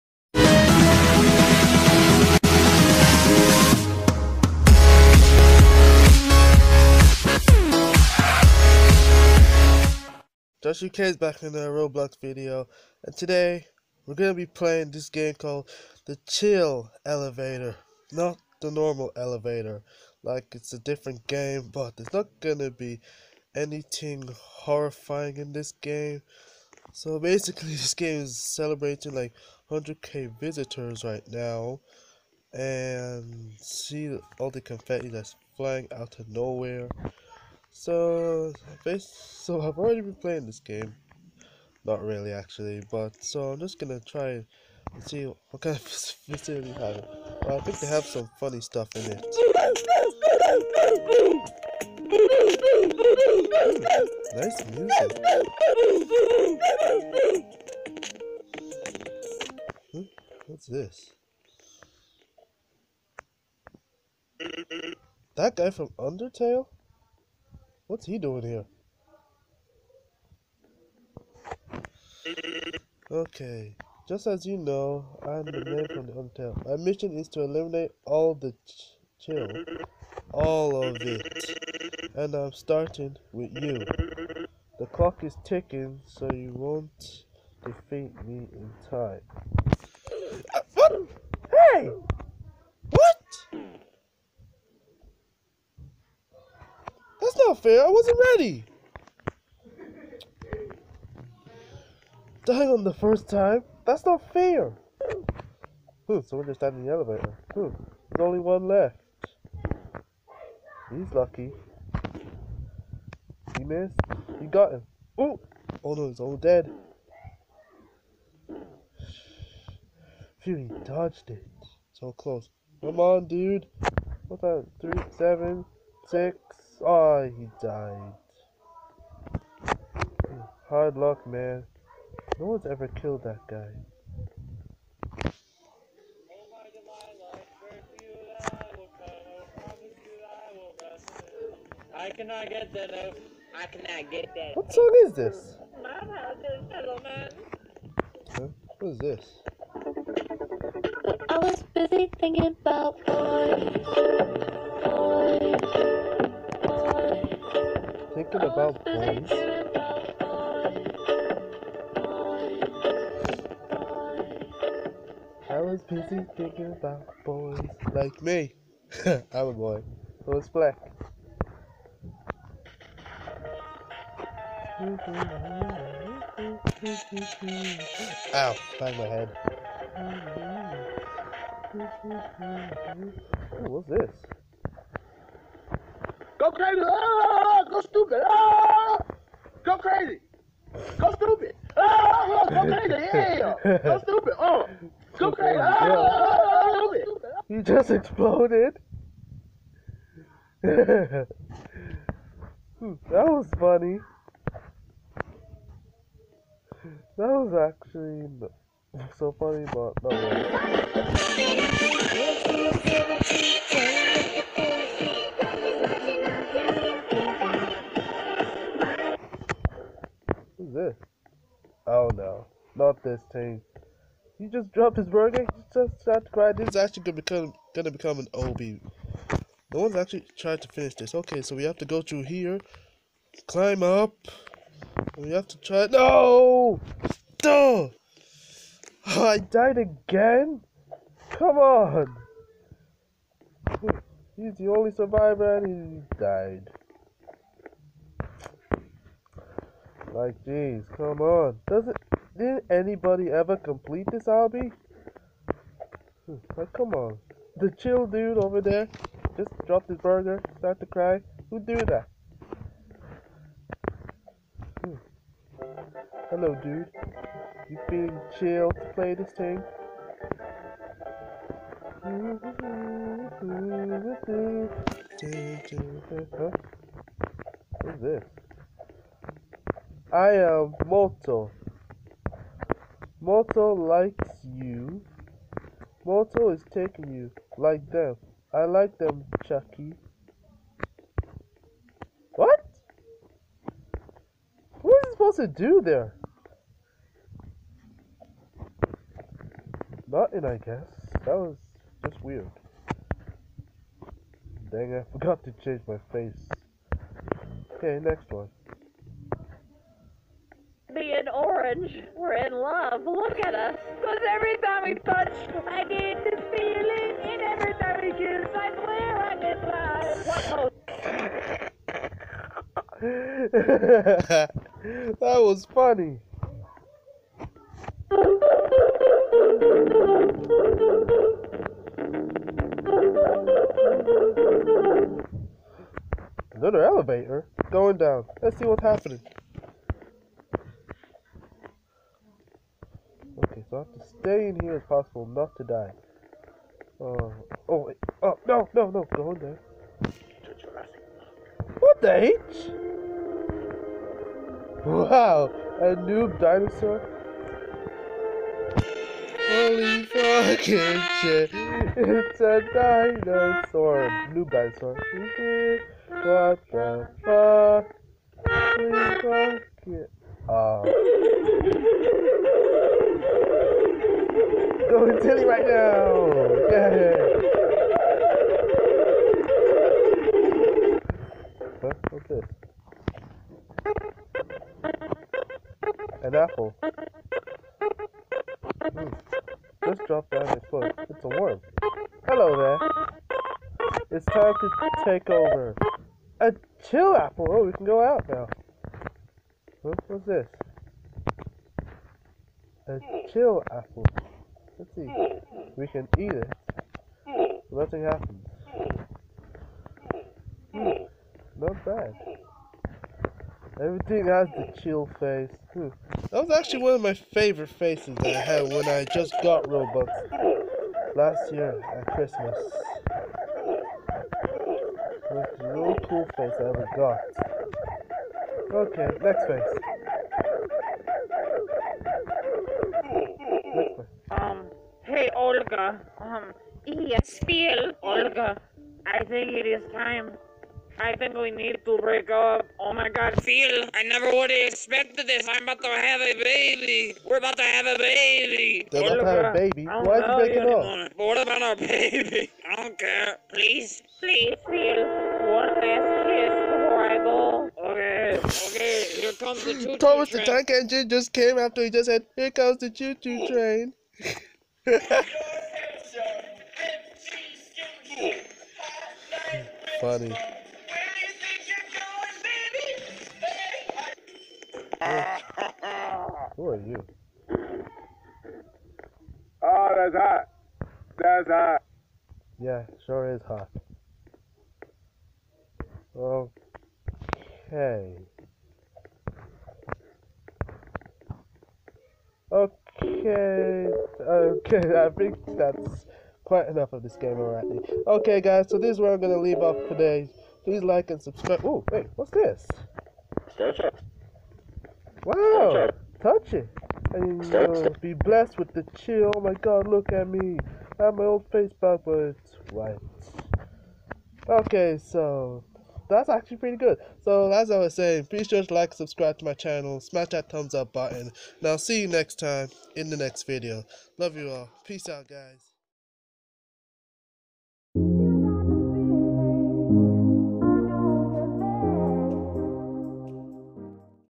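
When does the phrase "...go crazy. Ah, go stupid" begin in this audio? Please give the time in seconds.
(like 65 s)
195 s.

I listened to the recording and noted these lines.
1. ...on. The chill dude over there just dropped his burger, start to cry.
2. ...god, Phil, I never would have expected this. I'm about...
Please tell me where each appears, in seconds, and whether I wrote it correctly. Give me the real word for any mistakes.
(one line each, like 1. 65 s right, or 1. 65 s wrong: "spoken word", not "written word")
1. 256 s right
2. 443 s right.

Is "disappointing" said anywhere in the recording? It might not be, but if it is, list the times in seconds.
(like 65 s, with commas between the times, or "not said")
not said.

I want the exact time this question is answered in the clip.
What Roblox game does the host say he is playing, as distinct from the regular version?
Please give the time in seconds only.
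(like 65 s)
16 s.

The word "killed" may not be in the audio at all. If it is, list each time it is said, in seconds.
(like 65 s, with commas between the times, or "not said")
132 s.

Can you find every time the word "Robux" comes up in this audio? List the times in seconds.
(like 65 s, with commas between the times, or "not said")
419 s.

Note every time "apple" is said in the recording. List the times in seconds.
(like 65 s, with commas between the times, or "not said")
386 s, 397 s, 403 s.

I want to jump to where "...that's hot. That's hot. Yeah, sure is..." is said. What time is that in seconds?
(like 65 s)
479 s.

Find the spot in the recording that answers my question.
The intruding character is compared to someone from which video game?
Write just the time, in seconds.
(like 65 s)
65 s.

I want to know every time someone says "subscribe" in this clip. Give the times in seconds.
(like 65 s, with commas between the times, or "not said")
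501 s, 518 s.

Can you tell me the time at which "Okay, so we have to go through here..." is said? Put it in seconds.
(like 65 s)
231 s.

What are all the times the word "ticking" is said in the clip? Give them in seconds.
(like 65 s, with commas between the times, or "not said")
85 s.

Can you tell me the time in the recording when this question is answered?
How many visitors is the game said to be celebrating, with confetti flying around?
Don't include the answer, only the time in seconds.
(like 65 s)
29 s.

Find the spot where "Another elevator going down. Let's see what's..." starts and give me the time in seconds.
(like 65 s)
336 s.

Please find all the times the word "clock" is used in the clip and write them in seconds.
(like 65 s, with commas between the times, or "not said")
84 s.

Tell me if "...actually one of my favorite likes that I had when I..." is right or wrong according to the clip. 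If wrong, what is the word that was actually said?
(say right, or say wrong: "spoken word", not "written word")
wrong: "faces", not "likes".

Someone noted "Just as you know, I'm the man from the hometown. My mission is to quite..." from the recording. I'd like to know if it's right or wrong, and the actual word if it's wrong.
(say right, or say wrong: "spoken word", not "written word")
wrong: "eliminate", not "quite".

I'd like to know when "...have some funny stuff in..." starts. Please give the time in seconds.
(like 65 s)
47 s.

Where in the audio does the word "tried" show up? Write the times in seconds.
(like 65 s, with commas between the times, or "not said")
226 s, 230 s.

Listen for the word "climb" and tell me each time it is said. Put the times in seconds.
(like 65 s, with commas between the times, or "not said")
233 s.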